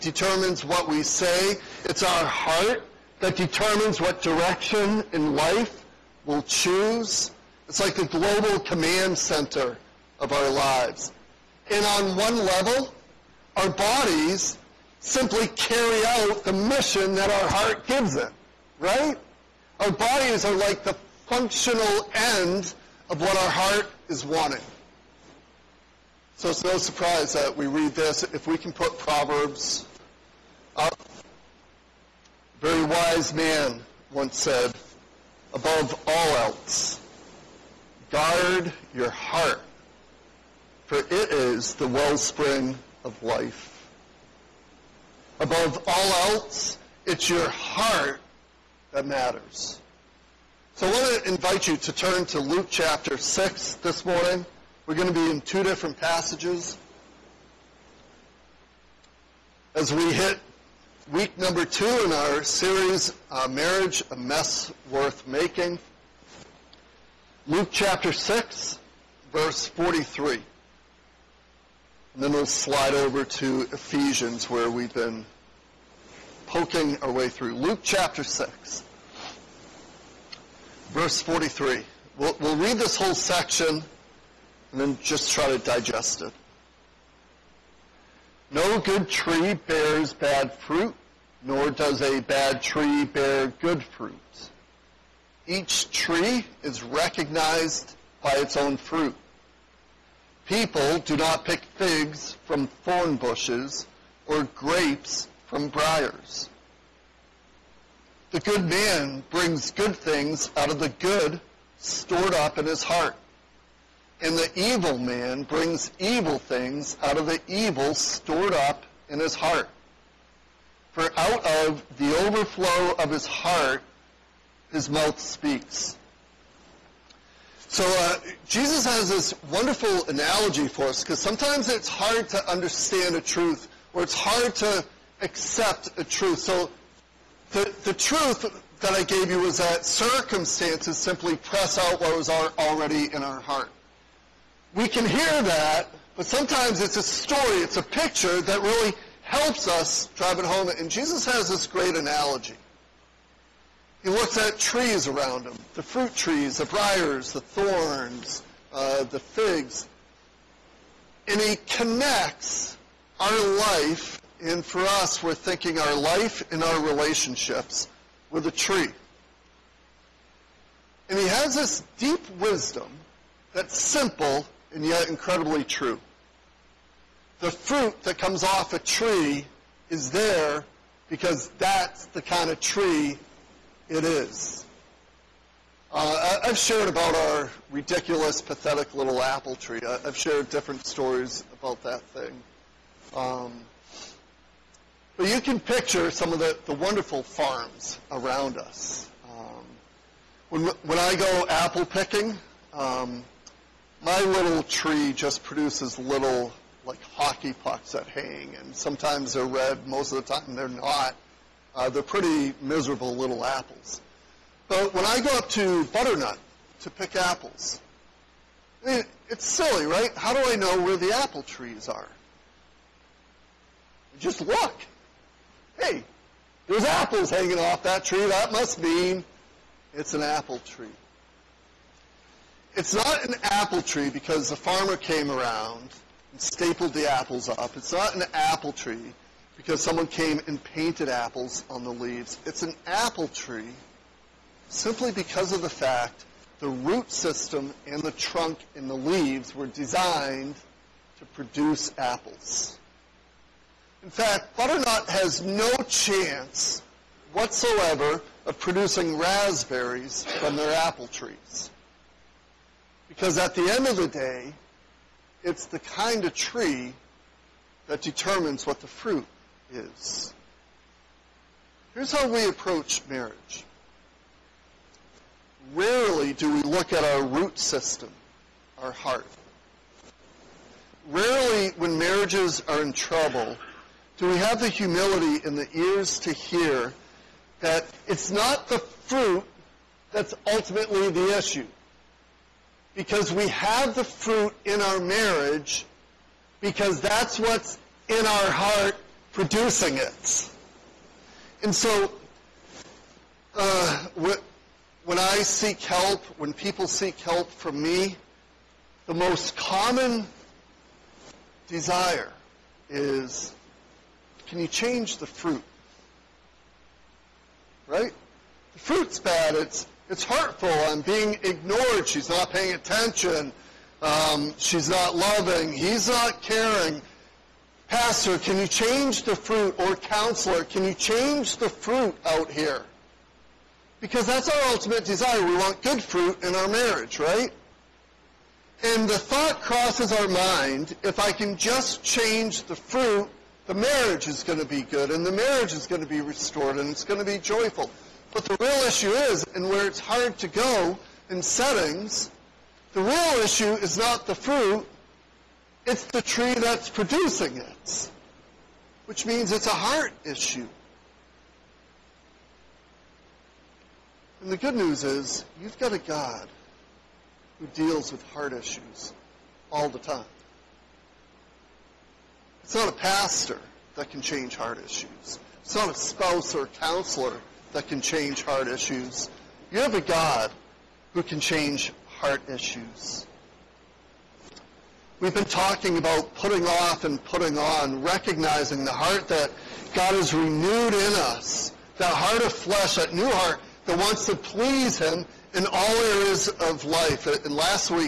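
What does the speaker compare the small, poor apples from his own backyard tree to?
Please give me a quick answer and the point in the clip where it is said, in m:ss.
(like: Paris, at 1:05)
hockey pucks, at 3:27.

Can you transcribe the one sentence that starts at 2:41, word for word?
And he connects our life, and for us, we're thinking our life and our relationships with a tree.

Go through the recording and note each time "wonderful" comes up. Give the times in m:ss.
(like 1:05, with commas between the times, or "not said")
2:09, 3:16.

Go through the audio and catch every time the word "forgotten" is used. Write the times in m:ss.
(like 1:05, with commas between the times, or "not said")
not said.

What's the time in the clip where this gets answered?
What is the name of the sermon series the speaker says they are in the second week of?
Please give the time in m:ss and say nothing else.
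1:03.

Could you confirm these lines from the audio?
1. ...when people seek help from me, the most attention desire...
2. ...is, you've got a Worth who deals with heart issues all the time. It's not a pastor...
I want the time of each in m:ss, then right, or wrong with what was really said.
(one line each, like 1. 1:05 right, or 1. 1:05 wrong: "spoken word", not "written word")
1. 5:06 wrong: "common", not "attention"
2. 6:05 wrong: "God", not "Worth".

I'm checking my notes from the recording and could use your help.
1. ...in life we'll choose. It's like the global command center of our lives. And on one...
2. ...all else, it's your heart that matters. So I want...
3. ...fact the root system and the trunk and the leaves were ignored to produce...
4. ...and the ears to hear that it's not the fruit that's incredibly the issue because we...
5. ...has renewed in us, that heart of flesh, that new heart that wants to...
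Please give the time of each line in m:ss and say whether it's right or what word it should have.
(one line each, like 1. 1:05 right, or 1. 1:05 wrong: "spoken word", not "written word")
1. 0:05 right
2. 0:45 right
3. 4:05 wrong: "designed", not "ignored"
4. 4:45 wrong: "ultimately", not "incredibly"
5. 6:30 right.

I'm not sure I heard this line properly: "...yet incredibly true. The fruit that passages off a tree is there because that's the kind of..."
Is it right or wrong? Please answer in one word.
wrong.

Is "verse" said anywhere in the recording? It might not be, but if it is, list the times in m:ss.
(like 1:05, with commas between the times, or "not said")
1:09, 1:20.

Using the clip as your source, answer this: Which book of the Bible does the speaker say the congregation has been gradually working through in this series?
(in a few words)
Ephesians.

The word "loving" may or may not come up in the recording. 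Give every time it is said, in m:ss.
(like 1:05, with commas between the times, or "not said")
5:25.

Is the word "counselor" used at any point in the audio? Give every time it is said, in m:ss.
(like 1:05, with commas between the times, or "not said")
5:29, 6:16.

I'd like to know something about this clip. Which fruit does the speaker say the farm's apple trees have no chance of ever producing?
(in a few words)
raspberries.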